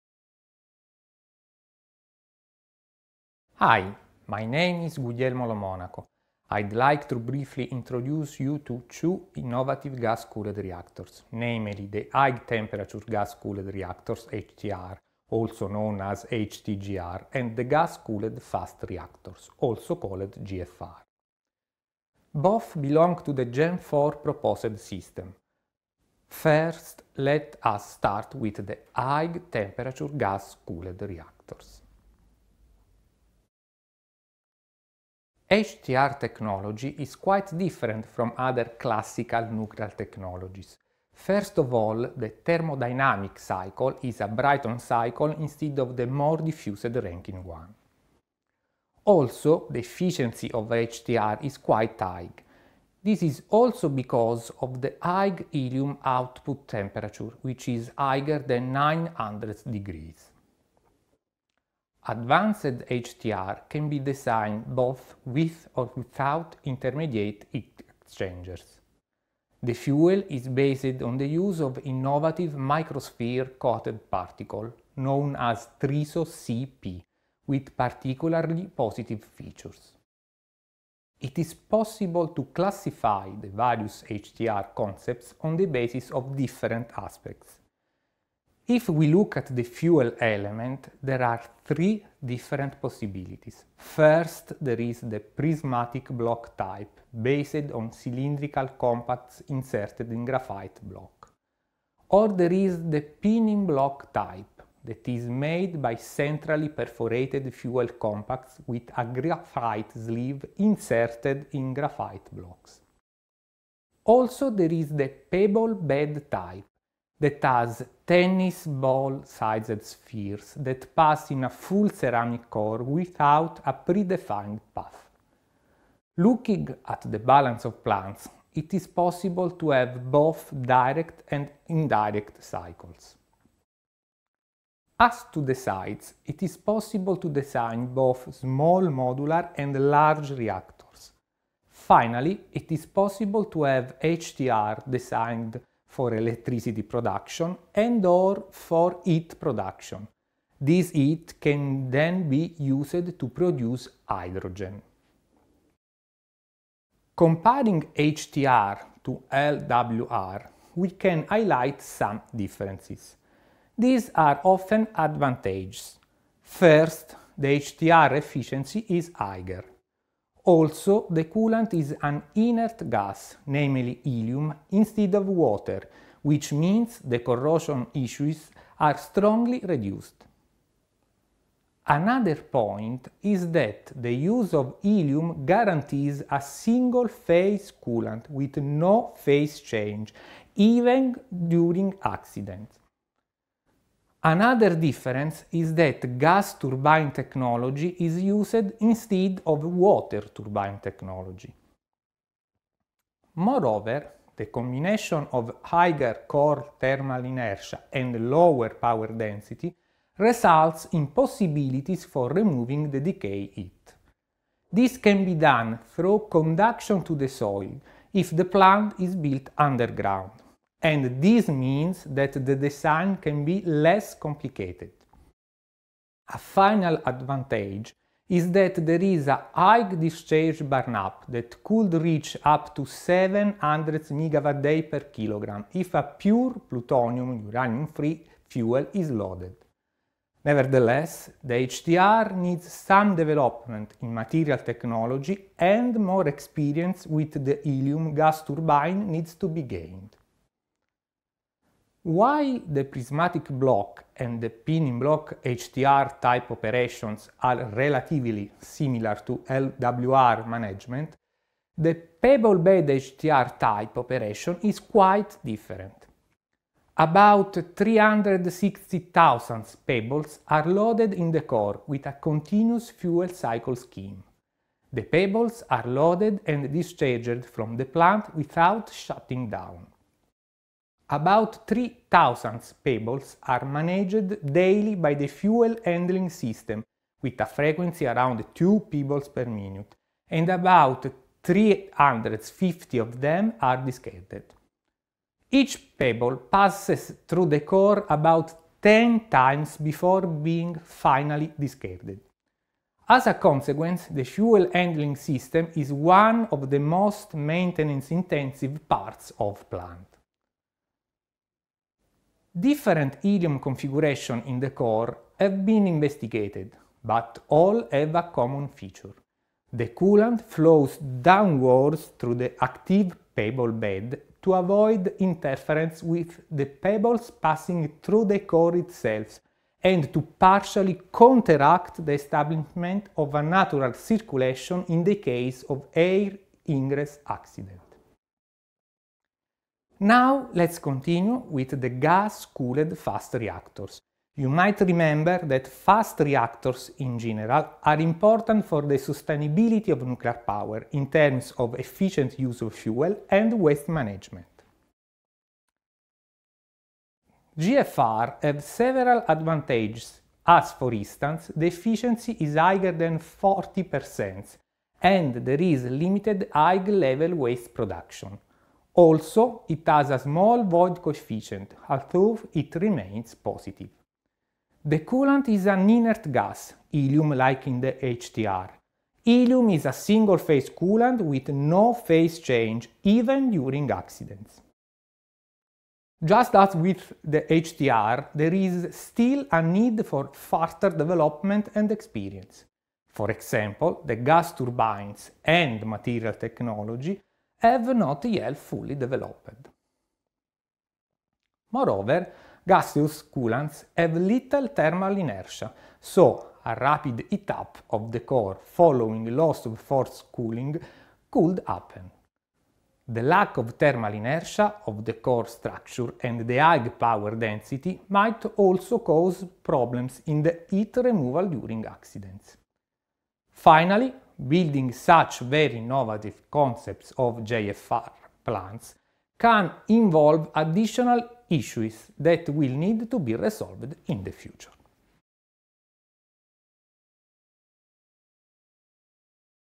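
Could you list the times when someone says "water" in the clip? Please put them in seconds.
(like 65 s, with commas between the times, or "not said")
175 s, 199 s.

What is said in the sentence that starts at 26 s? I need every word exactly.
First, let us start with the high-temperature gas-cooled reactors.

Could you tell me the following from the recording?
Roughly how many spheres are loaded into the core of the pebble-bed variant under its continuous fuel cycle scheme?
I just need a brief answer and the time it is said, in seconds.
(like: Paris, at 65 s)
360,000, at 267 s.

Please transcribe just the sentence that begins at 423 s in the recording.
Finally, building such very innovative concepts of GFR plants can involve additional issues that will need to be resolved in the future.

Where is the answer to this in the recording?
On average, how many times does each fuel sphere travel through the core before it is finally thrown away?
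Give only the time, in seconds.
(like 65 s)
298 s.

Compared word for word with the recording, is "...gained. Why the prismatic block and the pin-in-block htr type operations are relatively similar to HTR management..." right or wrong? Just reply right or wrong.
wrong.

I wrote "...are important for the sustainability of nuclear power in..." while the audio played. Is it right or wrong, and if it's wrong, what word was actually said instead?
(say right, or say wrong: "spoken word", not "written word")
right.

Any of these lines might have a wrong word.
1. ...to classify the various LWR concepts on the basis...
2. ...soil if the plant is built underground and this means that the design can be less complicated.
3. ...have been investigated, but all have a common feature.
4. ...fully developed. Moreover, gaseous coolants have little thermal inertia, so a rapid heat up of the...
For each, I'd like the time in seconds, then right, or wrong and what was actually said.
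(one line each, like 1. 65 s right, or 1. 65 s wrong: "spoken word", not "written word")
1. 82 s wrong: "HTR", not "LWR"
2. 217 s right
3. 315 s right
4. 398 s right.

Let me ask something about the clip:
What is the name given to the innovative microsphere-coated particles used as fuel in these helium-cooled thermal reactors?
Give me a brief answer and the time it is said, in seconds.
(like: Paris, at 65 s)
TRISO-CP, at 75 s.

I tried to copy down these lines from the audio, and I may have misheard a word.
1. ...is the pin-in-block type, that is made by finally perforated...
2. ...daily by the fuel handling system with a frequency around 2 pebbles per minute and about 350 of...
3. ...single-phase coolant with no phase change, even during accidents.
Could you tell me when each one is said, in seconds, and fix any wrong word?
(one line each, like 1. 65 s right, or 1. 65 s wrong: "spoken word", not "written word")
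1. 102 s wrong: "centrally", not "finally"
2. 284 s right
3. 379 s right.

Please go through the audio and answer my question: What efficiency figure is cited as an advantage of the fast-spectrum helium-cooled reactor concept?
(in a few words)
higher than 40%.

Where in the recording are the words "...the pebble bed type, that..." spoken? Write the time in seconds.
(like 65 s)
114 s.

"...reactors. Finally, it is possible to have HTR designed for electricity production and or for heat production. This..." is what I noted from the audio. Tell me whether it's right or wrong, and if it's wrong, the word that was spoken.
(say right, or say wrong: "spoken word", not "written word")
right.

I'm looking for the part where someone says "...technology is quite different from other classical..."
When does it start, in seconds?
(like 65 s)
36 s.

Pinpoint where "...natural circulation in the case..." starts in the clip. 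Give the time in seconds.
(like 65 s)
333 s.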